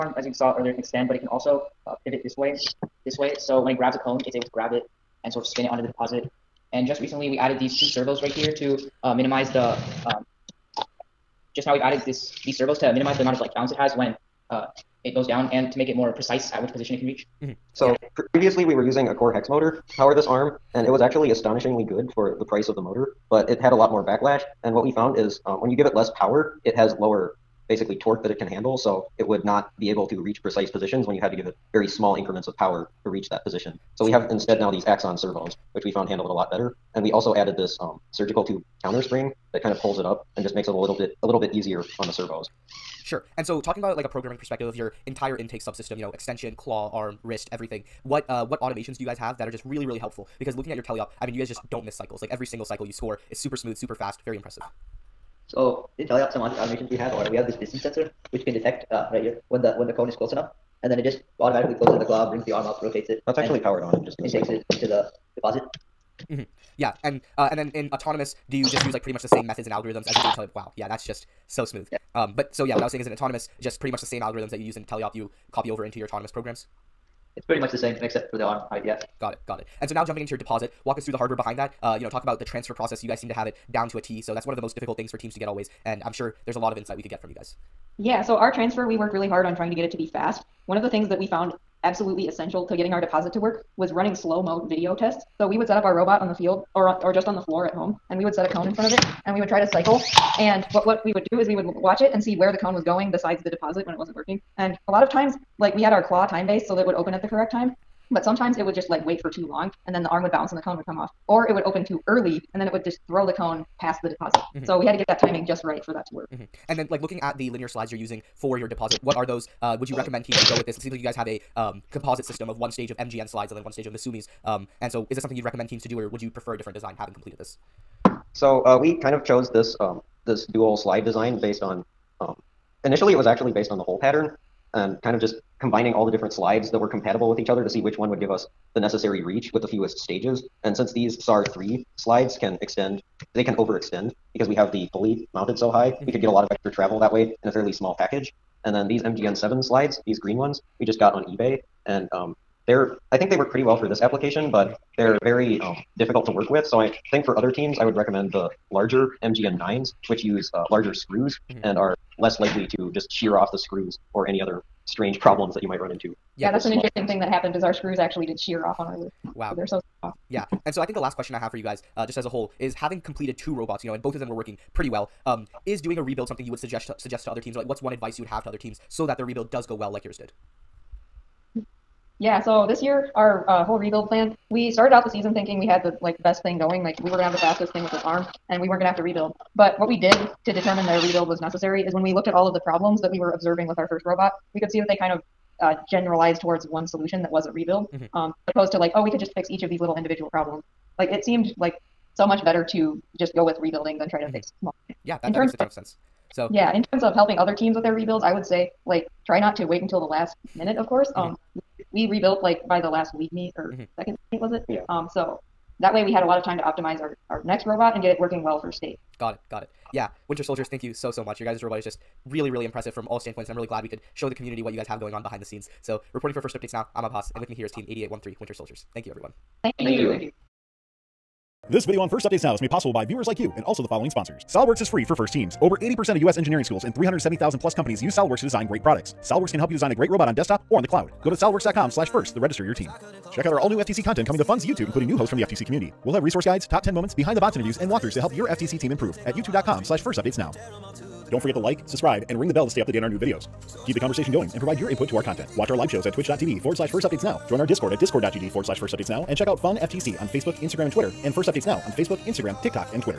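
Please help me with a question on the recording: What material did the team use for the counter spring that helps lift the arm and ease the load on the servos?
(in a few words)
surgical tube.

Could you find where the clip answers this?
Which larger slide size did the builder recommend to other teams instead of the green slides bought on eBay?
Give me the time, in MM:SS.
02:39.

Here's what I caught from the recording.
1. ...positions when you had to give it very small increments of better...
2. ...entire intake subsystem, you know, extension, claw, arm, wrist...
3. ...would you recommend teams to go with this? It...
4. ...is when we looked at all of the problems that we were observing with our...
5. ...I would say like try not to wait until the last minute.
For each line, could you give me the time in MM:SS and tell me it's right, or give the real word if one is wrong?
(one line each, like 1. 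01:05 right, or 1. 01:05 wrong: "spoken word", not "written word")
1. 00:30 wrong: "power", not "better"
2. 00:45 right
3. 01:59 right
4. 03:11 right
5. 03:28 right.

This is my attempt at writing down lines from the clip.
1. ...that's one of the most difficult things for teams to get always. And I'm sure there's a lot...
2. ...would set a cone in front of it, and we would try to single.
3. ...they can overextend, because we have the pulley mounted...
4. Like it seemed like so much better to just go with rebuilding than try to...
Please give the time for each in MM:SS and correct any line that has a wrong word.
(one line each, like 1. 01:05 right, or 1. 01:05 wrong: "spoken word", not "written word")
1. 01:24 right
2. 01:38 wrong: "cycle", not "single"
3. 02:23 right
4. 03:20 right.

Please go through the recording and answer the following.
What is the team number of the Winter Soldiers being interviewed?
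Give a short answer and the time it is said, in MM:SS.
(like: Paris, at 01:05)
8813, at 03:47.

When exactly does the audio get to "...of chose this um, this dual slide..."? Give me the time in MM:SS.
02:09.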